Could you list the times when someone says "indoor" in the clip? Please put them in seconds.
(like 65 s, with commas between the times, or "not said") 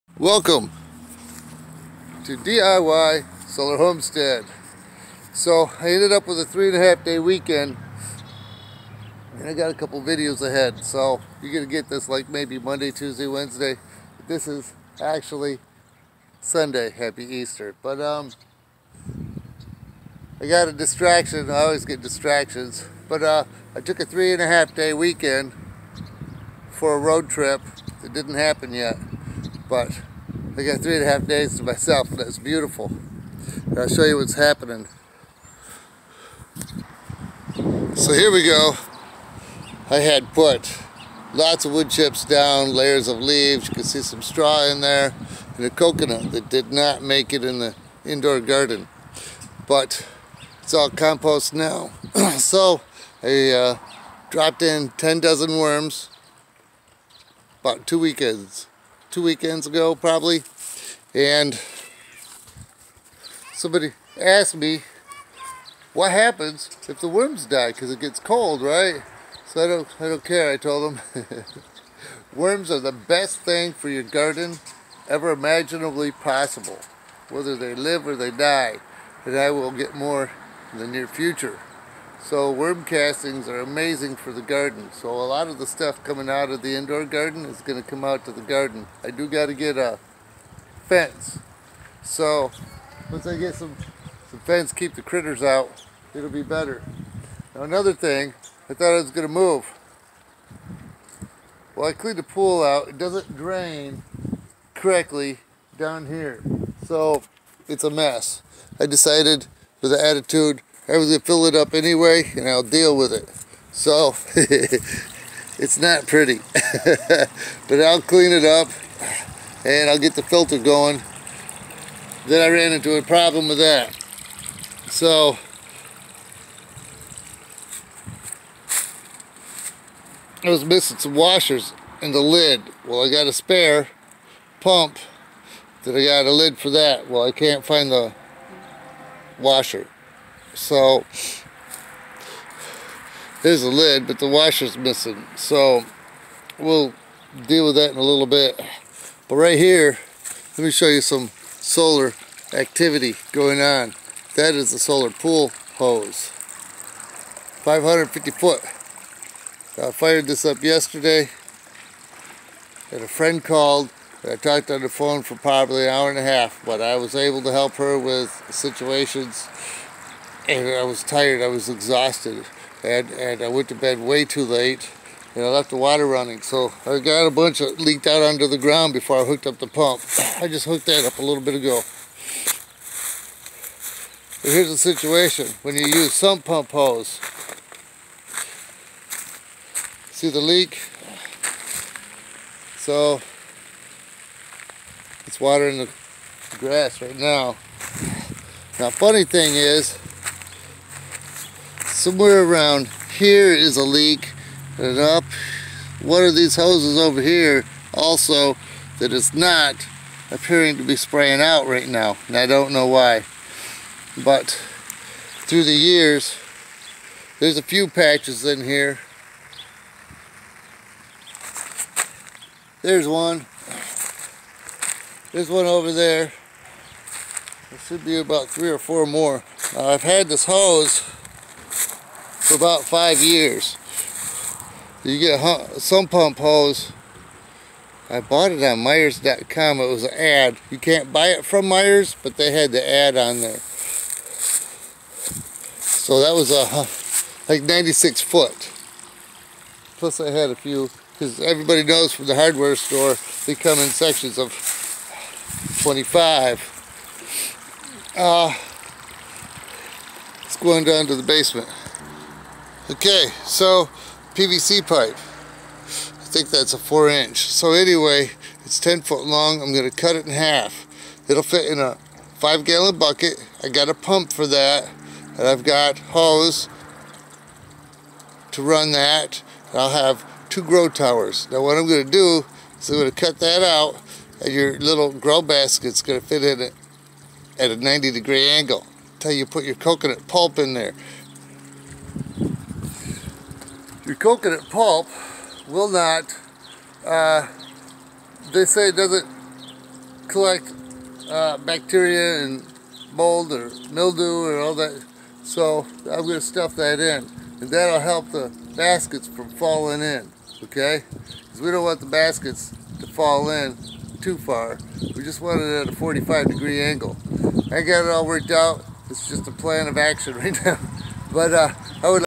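48 s, 86 s.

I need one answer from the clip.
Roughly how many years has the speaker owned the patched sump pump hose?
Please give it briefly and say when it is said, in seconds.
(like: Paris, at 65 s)
5 years, at 232 s.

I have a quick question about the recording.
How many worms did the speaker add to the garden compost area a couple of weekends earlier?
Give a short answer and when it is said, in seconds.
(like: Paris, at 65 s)
10 dozen, at 54 s.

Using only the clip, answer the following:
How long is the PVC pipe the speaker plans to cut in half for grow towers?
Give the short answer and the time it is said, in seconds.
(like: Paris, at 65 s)
10 foot, at 268 s.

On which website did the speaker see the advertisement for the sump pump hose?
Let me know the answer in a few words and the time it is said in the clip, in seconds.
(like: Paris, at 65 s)
Myers.com, at 238 s.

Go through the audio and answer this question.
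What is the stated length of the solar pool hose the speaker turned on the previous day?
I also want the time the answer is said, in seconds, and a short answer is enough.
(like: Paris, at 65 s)
550 foot, at 157 s.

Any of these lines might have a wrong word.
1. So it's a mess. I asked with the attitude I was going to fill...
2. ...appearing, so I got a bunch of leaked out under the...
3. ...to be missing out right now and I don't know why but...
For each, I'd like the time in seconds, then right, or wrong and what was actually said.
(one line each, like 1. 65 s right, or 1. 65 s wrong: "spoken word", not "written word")
1. 106 s wrong: "decided", not "asked"
2. 176 s wrong: "running", not "appearing"
3. 210 s wrong: "spraying", not "missing".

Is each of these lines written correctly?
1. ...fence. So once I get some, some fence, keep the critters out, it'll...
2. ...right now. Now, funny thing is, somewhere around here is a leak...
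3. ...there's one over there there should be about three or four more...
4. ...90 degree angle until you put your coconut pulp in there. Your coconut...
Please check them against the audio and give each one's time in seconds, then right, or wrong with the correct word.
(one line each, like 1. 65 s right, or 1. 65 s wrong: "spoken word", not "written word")
1. 90 s right
2. 196 s right
3. 225 s right
4. 287 s right.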